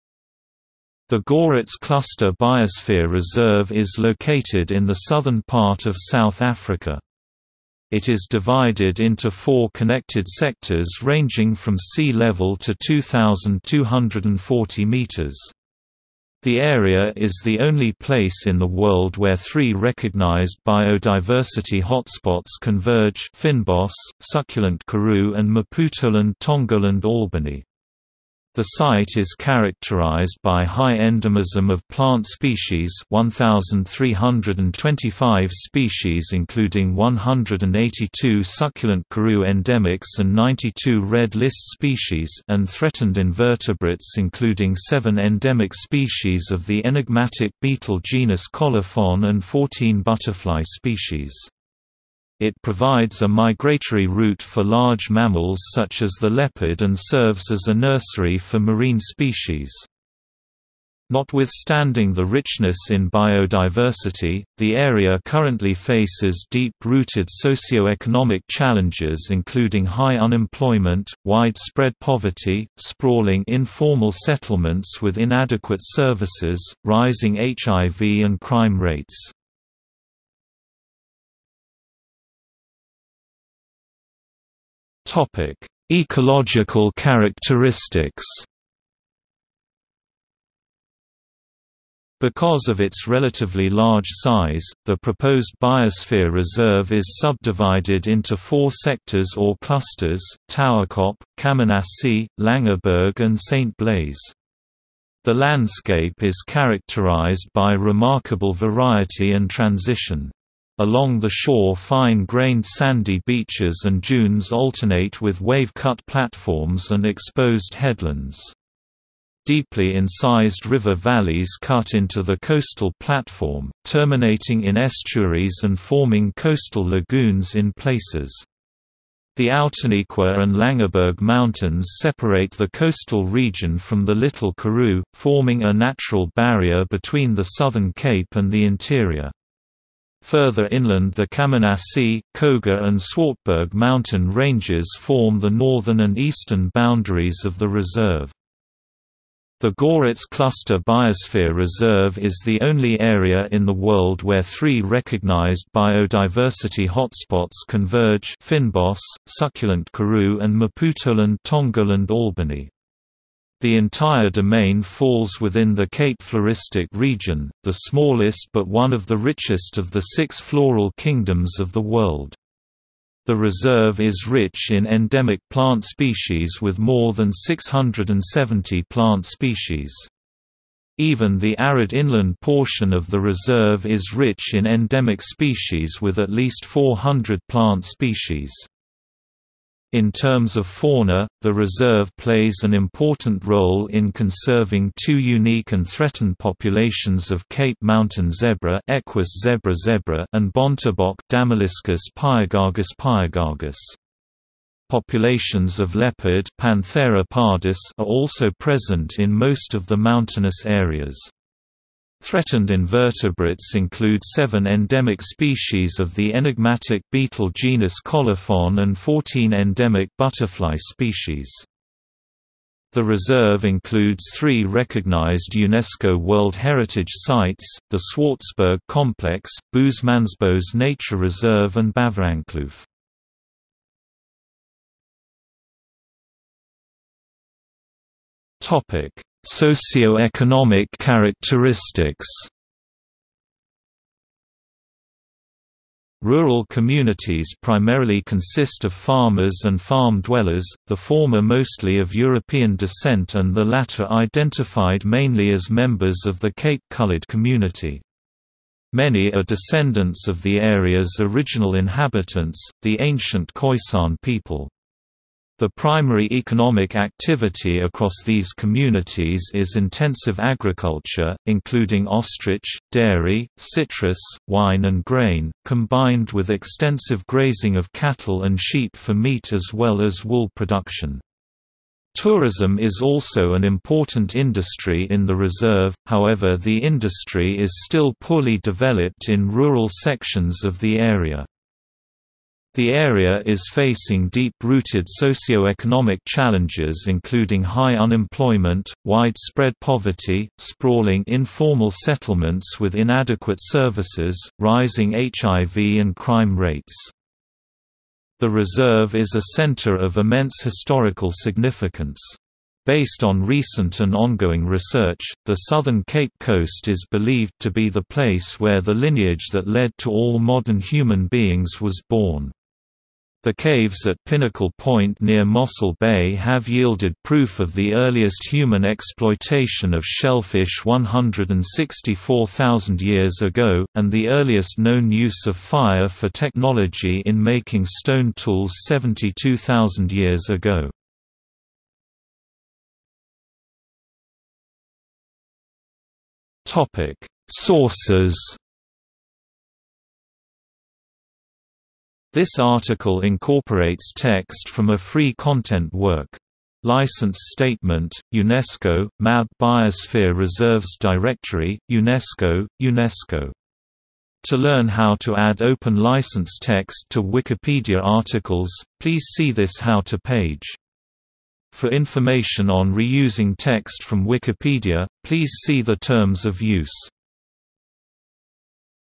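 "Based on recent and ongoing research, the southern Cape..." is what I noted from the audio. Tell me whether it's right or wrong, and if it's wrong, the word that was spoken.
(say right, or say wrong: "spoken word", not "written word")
right.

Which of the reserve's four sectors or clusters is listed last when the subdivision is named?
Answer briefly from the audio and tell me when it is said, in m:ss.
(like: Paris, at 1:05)
St. Blaize, at 1:43.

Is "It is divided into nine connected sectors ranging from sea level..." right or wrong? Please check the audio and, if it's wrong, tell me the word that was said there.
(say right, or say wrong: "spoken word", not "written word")
wrong: "four", not "nine".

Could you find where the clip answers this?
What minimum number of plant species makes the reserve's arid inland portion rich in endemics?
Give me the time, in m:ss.
3:06.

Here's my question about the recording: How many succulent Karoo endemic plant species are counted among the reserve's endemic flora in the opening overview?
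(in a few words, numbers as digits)
182.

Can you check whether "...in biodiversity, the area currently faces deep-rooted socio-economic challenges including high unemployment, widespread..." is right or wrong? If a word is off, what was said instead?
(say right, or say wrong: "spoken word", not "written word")
right.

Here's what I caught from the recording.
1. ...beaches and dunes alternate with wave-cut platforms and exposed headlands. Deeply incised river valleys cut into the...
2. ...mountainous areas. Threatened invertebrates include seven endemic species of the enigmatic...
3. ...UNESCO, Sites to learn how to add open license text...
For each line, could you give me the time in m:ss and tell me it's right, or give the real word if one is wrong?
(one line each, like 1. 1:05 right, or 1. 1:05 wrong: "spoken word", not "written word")
1. 1:53 right
2. 3:29 right
3. 6:01 wrong: "UNESCO", not "Sites".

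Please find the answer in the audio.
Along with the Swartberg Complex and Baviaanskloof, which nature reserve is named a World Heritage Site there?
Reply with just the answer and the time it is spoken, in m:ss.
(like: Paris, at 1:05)
Boosmansbos Nature Reserve, at 3:49.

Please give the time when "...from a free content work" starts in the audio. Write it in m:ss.
5:54.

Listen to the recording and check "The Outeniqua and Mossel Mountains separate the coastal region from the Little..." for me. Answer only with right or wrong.
wrong.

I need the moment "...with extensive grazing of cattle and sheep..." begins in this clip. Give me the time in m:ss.
4:36.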